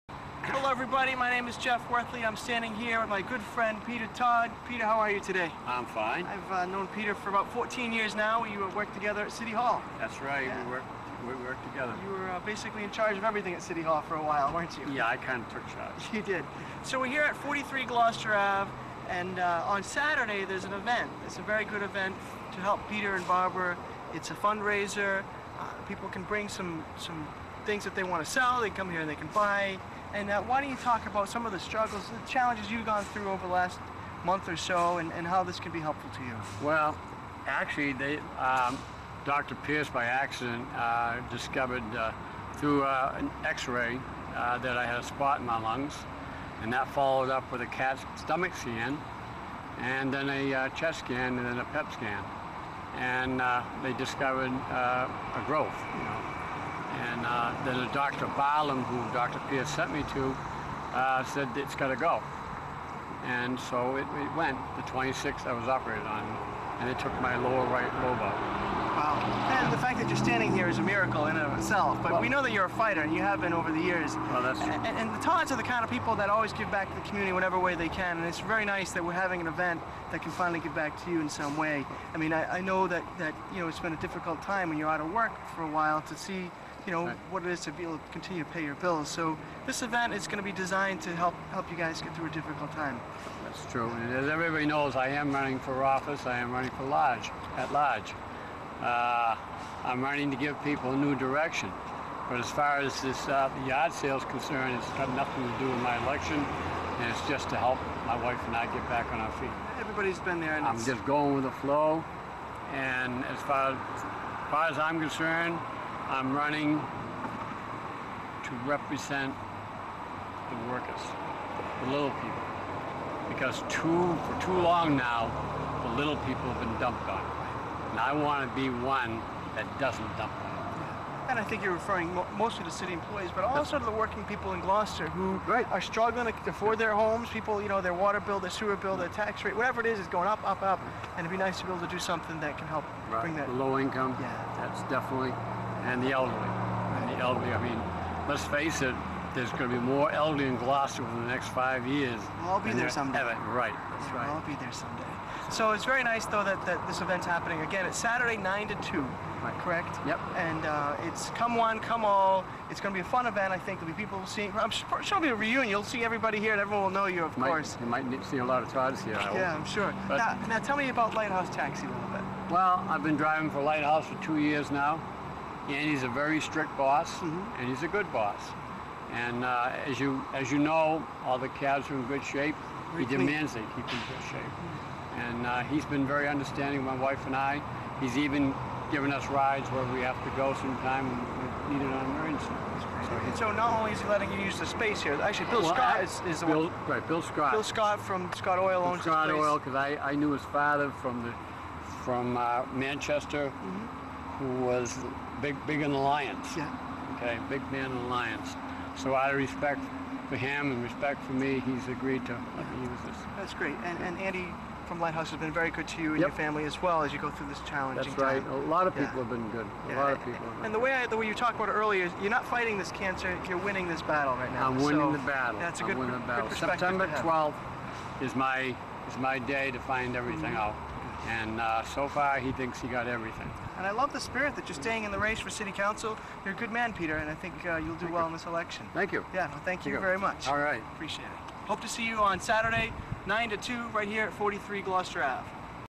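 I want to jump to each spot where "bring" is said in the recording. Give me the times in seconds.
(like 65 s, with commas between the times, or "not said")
26 s, 143 s.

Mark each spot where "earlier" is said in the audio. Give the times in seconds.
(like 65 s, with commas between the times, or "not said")
221 s.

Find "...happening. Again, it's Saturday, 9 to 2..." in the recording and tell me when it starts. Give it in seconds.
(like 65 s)
157 s.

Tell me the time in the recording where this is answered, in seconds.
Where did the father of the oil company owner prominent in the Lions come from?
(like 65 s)
202 s.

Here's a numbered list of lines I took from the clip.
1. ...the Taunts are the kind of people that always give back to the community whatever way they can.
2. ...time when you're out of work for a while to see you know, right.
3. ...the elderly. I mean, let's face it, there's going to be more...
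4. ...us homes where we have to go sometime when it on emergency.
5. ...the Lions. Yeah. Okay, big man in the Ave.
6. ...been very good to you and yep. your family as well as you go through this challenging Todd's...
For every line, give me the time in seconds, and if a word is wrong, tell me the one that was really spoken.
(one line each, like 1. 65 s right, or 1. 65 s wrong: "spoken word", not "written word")
1. 75 s right
2. 84 s right
3. 147 s right
4. 189 s wrong: "rides", not "homes"
5. 205 s wrong: "Lions", not "Ave"
6. 215 s wrong: "That", not "Todd".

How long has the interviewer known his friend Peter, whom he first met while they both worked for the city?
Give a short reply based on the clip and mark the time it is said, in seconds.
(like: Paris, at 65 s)
14 years, at 7 s.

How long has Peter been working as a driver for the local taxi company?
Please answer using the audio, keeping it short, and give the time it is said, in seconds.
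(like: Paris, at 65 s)
2 years, at 174 s.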